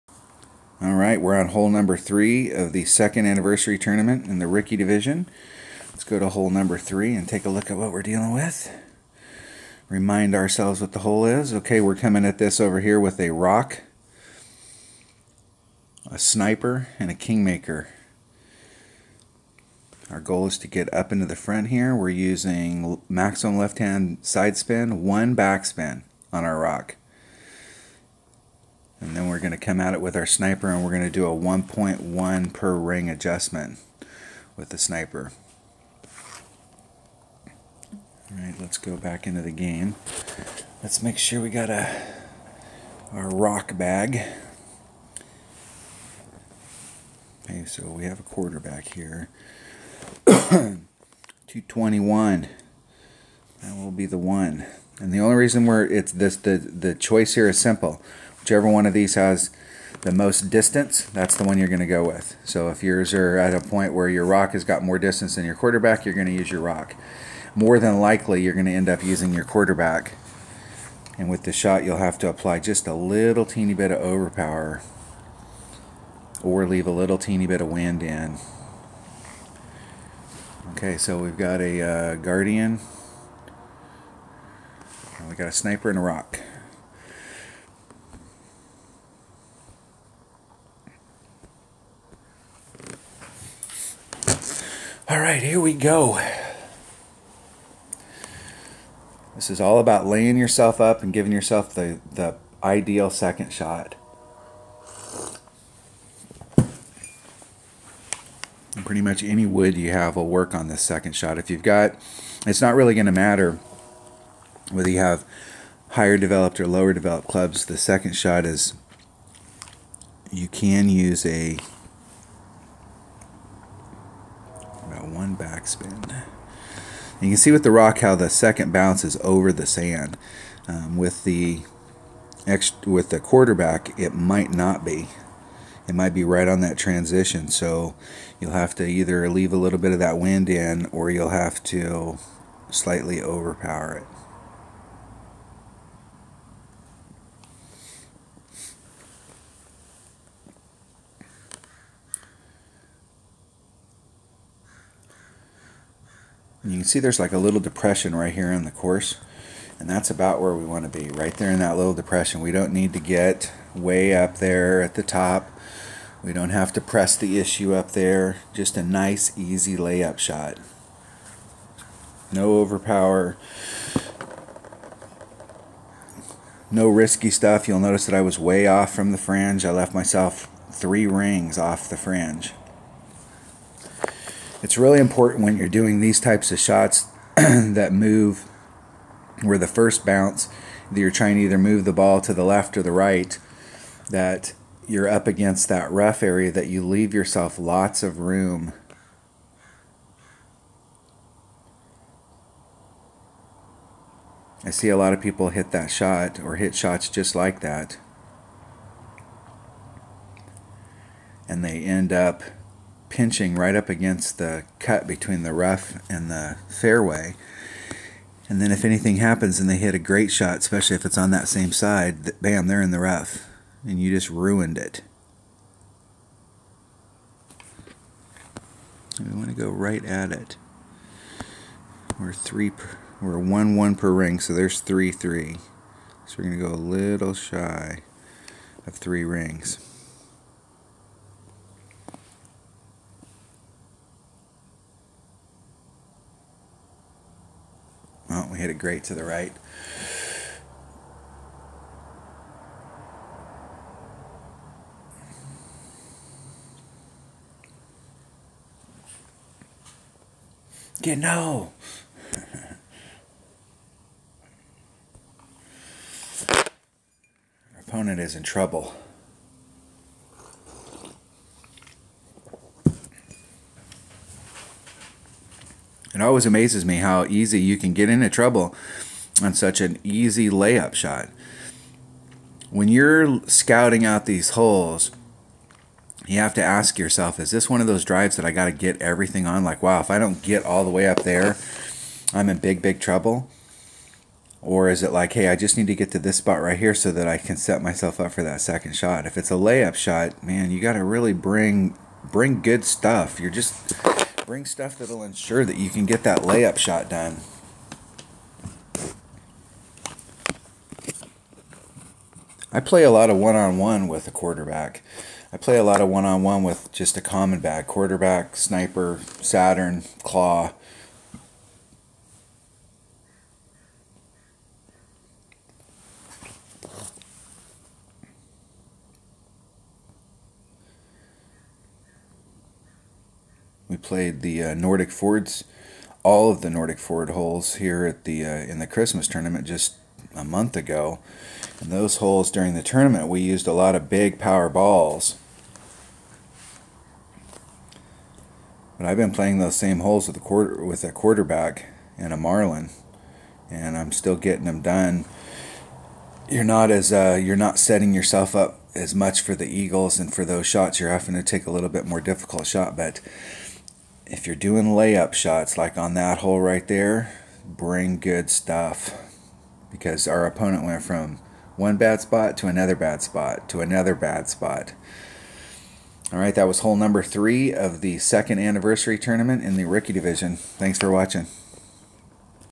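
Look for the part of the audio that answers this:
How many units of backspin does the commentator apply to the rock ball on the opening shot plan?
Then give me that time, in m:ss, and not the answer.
0:25.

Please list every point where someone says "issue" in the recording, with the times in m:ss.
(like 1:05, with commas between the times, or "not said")
2:47.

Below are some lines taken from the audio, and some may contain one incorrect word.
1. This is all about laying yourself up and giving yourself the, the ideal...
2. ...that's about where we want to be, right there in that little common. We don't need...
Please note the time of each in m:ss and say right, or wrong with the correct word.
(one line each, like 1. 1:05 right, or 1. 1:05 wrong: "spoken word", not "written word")
1. 1:39 right
2. 2:39 wrong: "depression", not "common".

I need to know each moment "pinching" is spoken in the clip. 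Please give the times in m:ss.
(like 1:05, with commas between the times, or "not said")
3:33.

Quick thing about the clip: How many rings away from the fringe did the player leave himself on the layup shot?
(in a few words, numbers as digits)
3.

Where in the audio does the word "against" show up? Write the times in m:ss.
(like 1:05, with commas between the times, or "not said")
3:15, 3:33.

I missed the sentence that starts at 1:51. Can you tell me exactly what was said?
If you've got, it's not really going to matter whether you have higher developed or lower developed clubs.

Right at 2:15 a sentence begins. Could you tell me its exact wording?
It might be right on that transition.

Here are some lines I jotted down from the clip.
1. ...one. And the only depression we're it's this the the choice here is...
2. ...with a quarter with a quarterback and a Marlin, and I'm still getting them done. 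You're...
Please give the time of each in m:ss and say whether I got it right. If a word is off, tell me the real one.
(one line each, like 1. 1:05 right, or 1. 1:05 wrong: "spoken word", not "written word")
1. 0:54 wrong: "reason", not "depression"
2. 5:50 right.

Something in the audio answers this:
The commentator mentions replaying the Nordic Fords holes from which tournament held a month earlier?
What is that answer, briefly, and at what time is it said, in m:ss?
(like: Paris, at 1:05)
Christmas tournament, at 5:38.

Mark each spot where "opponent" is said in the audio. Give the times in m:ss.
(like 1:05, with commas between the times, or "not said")
4:27, 6:10.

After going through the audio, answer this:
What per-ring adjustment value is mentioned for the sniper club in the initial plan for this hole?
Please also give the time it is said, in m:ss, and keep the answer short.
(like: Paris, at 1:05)
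1.1, at 0:31.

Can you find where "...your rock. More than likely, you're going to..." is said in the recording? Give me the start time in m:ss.
1:06.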